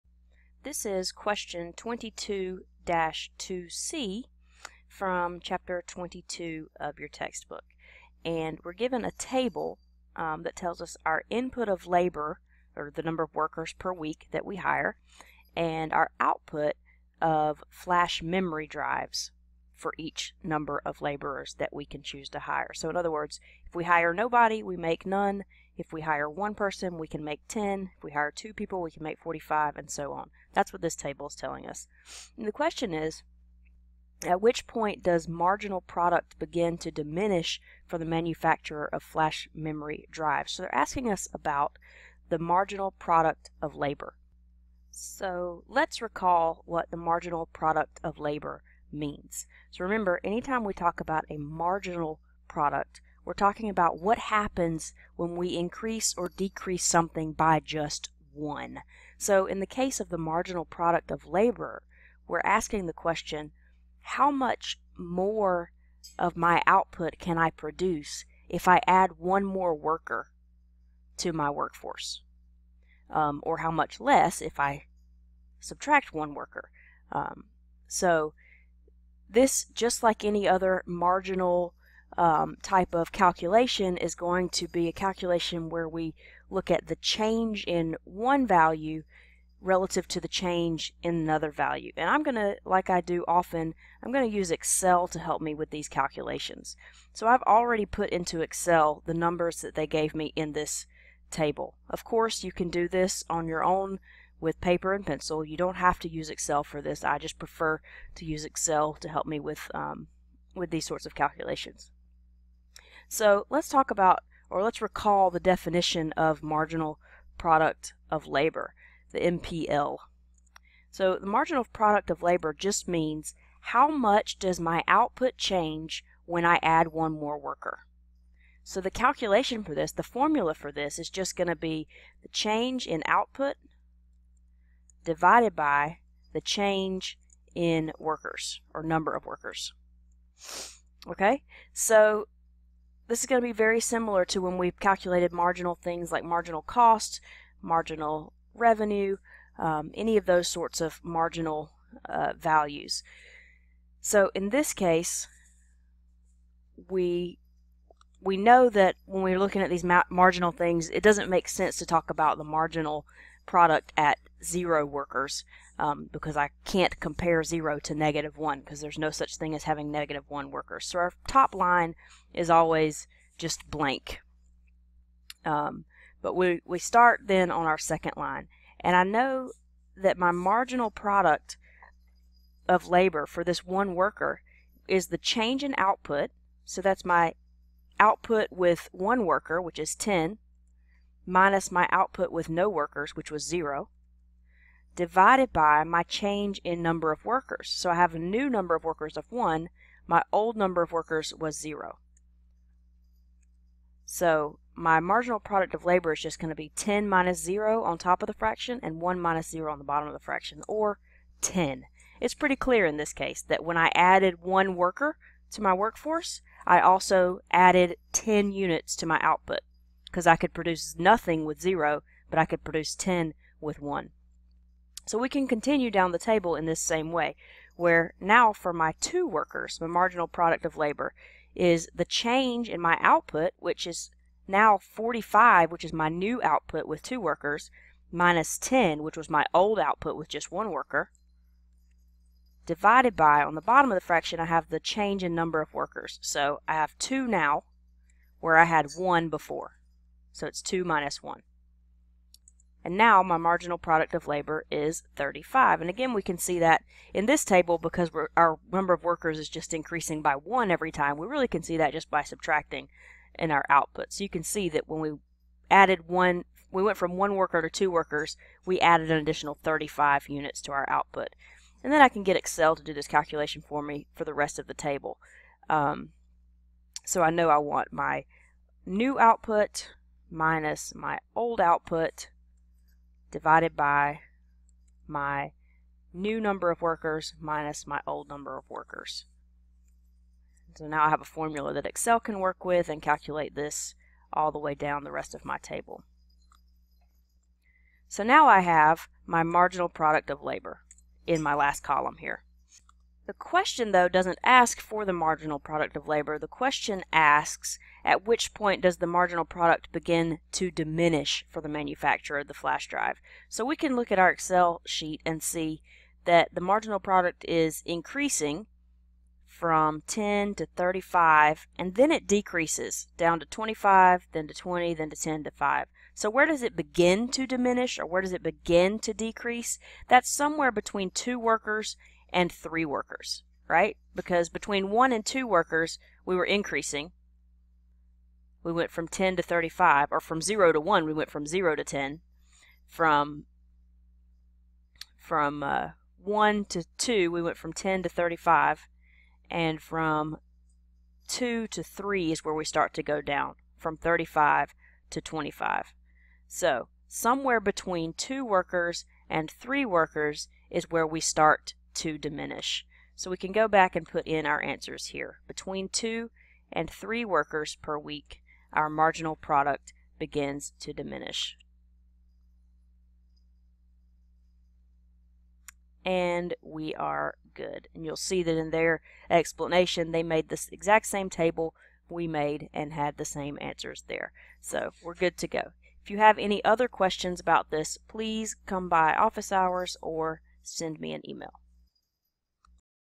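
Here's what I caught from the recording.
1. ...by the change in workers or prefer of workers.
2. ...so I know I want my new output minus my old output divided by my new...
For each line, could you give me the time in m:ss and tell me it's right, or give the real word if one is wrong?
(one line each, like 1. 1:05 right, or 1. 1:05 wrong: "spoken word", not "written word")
1. 2:15 wrong: "number", not "prefer"
2. 4:37 right.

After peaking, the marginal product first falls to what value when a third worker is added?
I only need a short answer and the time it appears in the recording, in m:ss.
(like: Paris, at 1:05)
25, at 5:23.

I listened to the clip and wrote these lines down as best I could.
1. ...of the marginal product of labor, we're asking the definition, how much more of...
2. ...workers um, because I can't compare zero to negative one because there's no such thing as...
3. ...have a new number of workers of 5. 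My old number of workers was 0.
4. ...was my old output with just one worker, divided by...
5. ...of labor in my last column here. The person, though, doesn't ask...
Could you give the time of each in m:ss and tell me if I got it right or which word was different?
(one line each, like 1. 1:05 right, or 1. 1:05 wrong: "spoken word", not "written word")
1. 0:59 wrong: "question", not "definition"
2. 2:44 right
3. 3:17 wrong: "1", not "5"
4. 3:59 right
5. 5:00 wrong: "question", not "person".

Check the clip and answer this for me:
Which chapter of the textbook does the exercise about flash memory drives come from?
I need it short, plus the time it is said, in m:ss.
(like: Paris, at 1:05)
22, at 0:05.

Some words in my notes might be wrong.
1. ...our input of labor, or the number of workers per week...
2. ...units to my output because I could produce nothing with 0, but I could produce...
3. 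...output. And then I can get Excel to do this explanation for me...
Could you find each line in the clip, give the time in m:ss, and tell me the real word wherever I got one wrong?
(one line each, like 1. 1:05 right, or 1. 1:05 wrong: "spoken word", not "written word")
1. 0:11 right
2. 3:38 right
3. 4:30 wrong: "calculation", not "explanation".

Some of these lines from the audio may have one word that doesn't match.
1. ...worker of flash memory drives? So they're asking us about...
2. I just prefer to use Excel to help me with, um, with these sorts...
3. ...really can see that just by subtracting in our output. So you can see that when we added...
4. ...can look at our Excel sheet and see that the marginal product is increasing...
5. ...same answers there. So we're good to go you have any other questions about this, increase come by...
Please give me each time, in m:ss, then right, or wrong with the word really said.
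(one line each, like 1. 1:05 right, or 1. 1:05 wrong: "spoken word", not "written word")
1. 0:38 wrong: "manufacturer", not "worker"
2. 1:47 right
3. 4:21 right
4. 5:13 right
5. 6:23 wrong: "please", not "increase".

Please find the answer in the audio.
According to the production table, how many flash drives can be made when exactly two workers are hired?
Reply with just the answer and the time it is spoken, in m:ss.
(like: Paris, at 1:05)
45, at 0:28.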